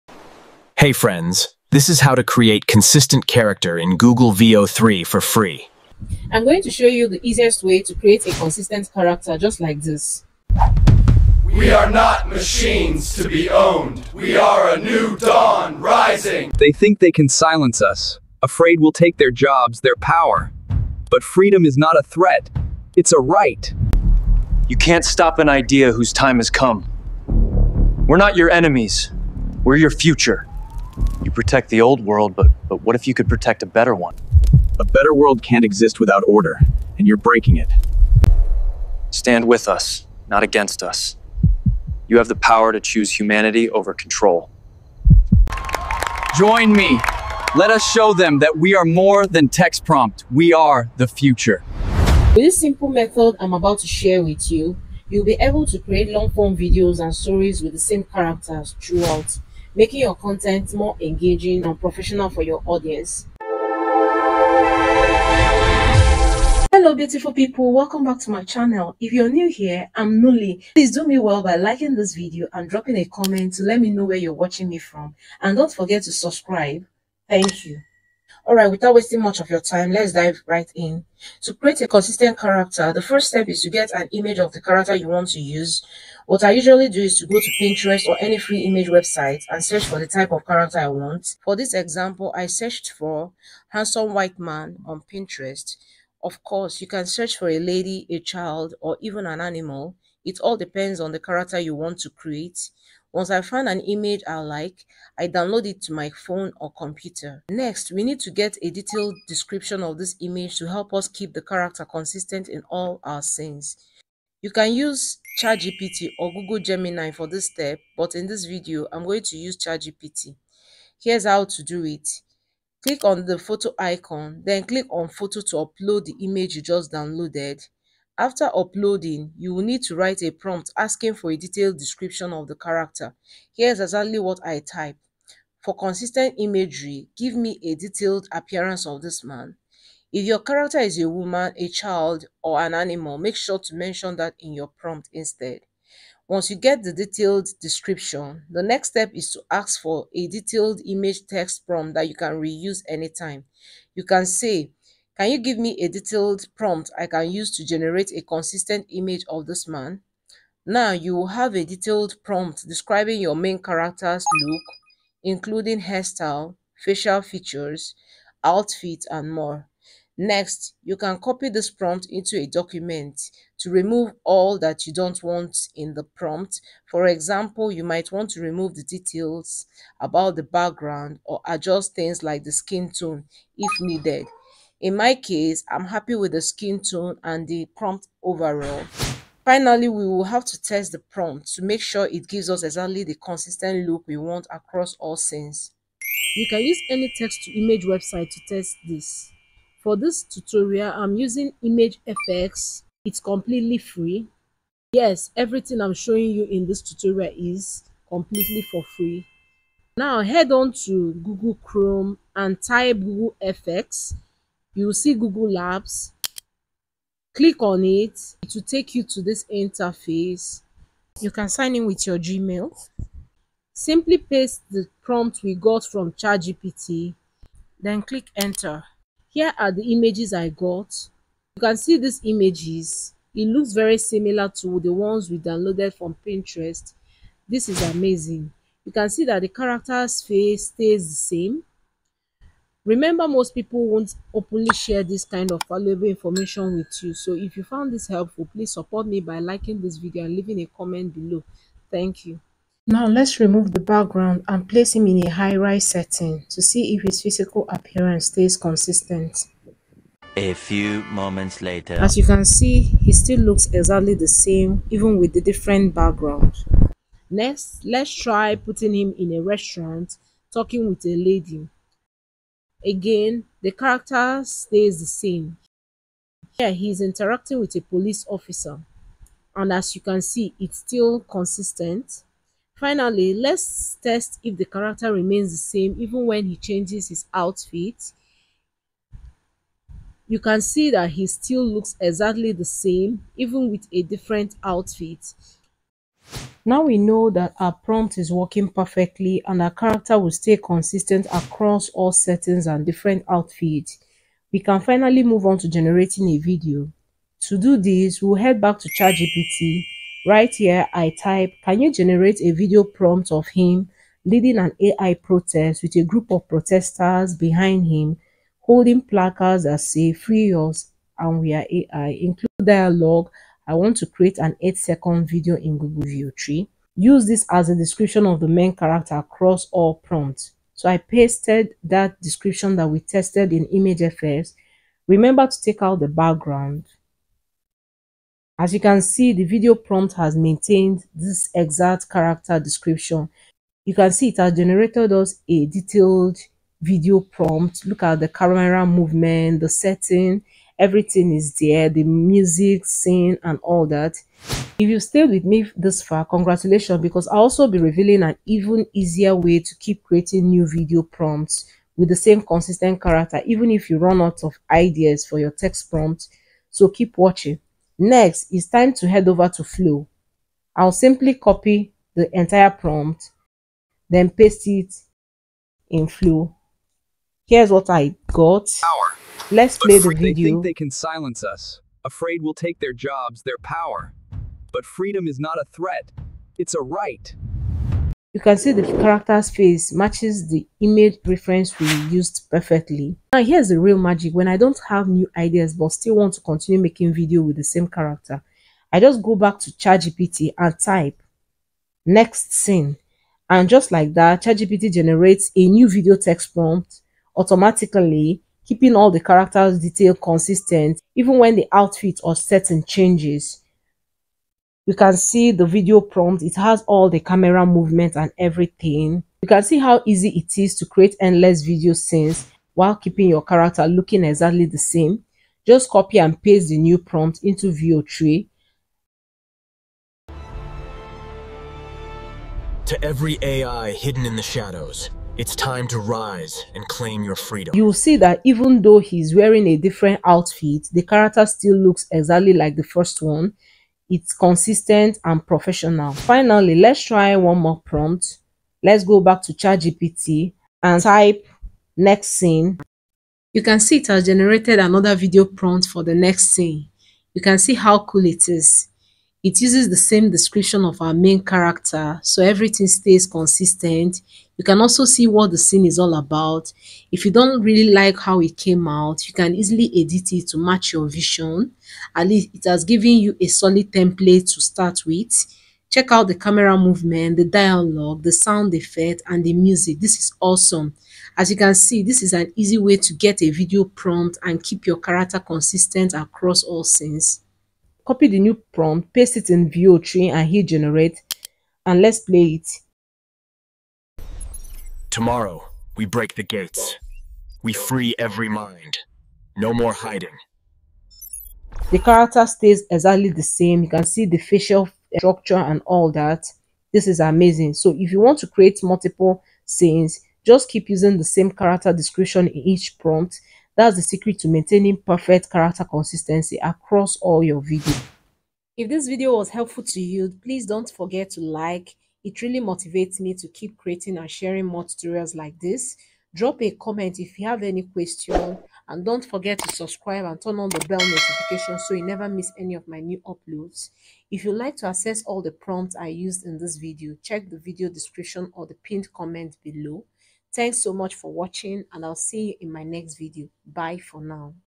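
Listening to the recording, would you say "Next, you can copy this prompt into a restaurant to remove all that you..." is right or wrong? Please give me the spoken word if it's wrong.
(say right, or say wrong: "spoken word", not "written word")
wrong: "document", not "restaurant".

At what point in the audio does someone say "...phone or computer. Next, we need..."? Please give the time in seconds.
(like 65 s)
106 s.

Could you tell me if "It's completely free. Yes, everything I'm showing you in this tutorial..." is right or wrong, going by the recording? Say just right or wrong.
right.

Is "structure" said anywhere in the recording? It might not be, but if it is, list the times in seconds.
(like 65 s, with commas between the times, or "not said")
505 s.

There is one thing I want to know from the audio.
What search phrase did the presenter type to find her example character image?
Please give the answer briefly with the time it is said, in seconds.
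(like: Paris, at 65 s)
handsome white man, at 93 s.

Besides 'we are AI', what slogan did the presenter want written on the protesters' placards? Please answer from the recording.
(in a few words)
free us.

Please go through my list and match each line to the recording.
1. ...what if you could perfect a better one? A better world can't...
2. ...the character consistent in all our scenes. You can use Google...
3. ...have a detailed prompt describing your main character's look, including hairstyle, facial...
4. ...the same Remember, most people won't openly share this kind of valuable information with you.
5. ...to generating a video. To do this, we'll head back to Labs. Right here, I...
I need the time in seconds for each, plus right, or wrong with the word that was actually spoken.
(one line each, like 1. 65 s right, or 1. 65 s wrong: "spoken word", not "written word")
1. 32 s wrong: "protect", not "perfect"
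2. 111 s wrong: "ChatGPT", not "Google"
3. 161 s right
4. 241 s right
5. 305 s wrong: "ChatGPT", not "Labs".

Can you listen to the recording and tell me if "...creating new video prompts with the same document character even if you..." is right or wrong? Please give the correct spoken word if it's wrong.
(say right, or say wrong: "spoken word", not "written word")
wrong: "consistent", not "document".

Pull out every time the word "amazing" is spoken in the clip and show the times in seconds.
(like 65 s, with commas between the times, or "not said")
237 s, 507 s.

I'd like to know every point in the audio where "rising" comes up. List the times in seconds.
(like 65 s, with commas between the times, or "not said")
15 s.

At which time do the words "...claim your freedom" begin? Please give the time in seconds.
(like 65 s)
436 s.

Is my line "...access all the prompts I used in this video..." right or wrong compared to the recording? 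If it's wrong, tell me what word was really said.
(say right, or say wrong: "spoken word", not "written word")
right.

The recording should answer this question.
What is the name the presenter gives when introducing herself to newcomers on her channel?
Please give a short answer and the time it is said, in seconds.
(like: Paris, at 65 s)
Nuli, at 70 s.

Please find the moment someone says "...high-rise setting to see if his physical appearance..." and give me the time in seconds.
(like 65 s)
255 s.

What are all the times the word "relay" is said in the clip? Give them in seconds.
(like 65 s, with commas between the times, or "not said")
not said.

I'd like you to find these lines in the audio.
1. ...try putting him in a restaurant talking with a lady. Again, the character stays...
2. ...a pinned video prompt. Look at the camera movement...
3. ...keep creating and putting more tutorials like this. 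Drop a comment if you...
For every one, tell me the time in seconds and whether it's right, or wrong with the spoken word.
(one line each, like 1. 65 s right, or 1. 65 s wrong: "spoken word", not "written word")
1. 268 s right
2. 345 s wrong: "detailed", not "pinned"
3. 523 s wrong: "sharing", not "putting".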